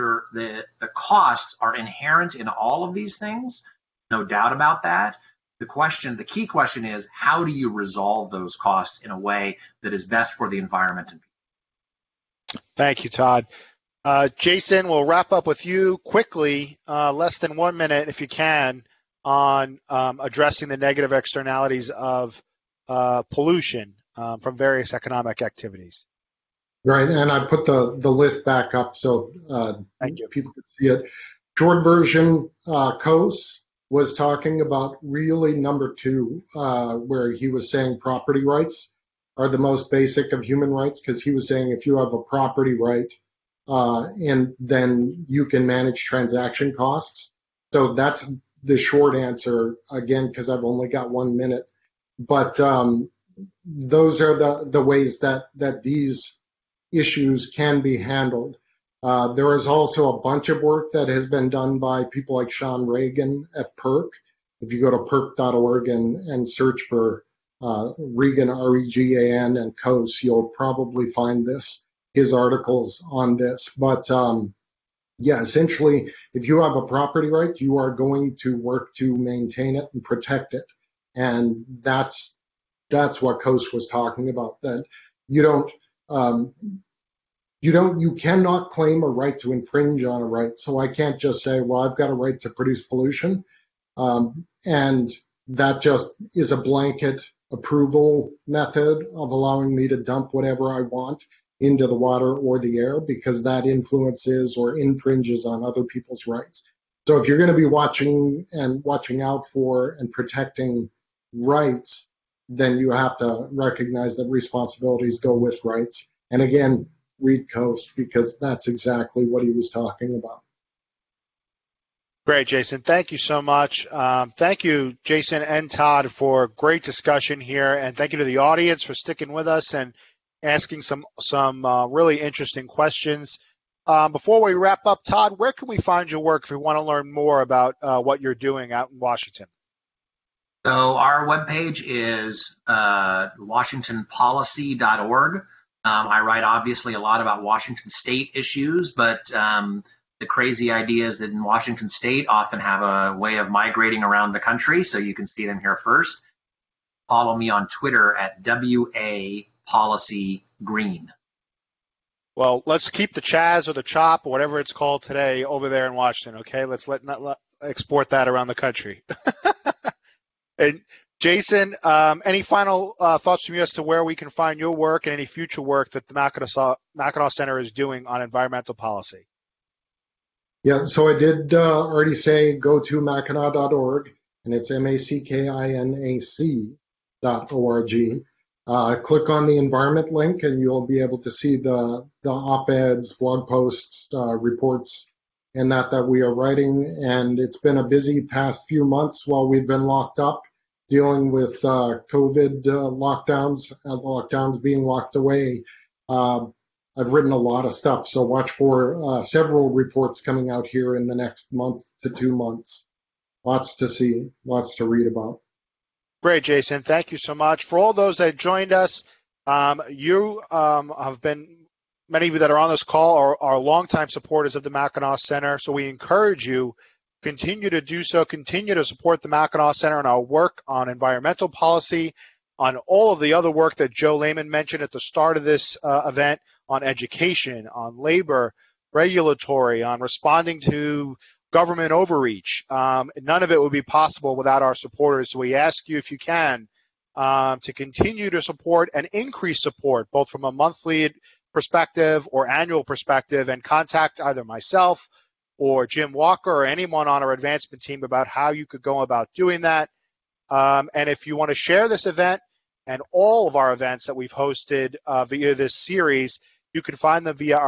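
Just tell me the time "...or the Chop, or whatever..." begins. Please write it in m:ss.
2:43.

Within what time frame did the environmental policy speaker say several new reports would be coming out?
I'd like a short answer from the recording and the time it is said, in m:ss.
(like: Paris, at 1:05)
next month to two months, at 3:31.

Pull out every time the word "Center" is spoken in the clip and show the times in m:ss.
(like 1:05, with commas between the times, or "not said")
2:57, 3:45, 3:49.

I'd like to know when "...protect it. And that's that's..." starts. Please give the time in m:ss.
1:20.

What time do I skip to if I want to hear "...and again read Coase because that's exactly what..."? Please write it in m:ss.
1:56.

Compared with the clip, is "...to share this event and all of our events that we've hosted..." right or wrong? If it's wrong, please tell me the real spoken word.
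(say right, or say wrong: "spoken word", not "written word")
right.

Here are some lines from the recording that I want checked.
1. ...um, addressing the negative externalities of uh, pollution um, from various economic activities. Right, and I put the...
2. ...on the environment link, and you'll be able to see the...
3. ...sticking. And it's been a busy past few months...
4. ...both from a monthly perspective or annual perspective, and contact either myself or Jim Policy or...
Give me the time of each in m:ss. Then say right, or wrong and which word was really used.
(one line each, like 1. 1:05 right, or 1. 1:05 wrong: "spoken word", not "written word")
1. 0:19 right
2. 3:09 right
3. 3:16 wrong: "writing", not "sticking"
4. 4:10 wrong: "Walker", not "Policy".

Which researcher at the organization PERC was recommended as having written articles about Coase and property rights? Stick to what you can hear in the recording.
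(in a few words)
Shawn Regan.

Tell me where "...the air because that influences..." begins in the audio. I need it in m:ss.
1:42.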